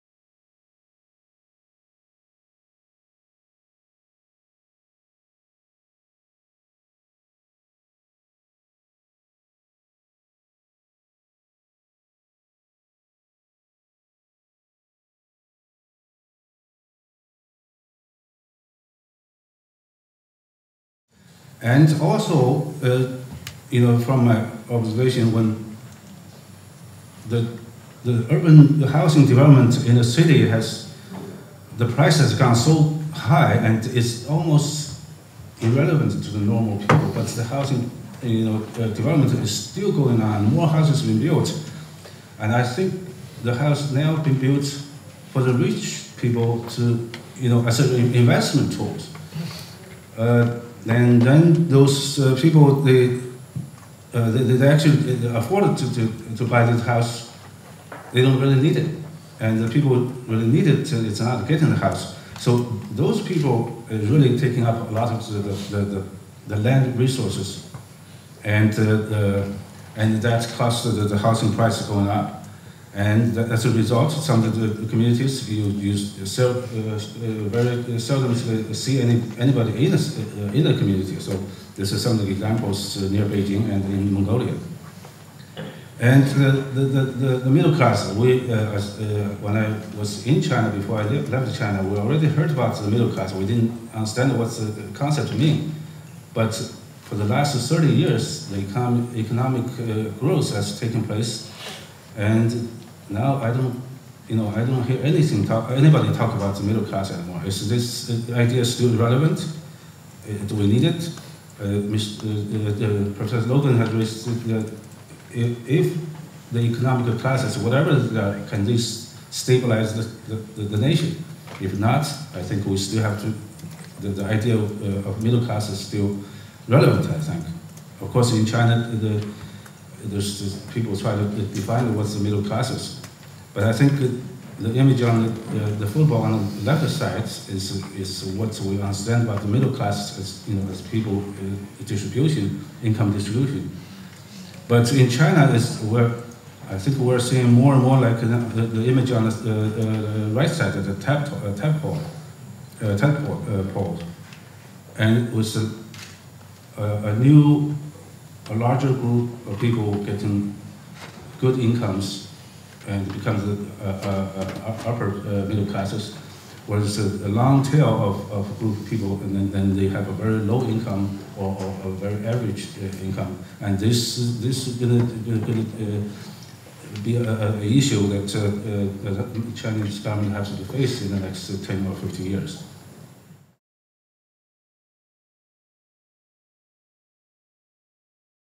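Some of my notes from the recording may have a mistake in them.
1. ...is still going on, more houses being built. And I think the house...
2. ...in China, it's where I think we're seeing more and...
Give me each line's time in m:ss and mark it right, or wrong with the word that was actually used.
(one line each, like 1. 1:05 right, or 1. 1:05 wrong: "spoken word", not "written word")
1. 0:39 right
2. 2:24 right.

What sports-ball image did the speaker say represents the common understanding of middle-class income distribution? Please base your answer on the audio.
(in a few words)
football.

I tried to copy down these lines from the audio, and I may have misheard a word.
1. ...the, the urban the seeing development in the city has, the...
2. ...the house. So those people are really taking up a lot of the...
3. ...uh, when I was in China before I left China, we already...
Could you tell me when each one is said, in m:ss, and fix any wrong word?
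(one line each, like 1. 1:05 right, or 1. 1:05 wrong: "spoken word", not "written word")
1. 0:27 wrong: "housing", not "seeing"
2. 1:01 right
3. 1:28 right.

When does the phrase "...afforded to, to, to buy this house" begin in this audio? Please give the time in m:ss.
0:55.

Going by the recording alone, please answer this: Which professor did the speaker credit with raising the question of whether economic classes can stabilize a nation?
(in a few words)
Professor Logan.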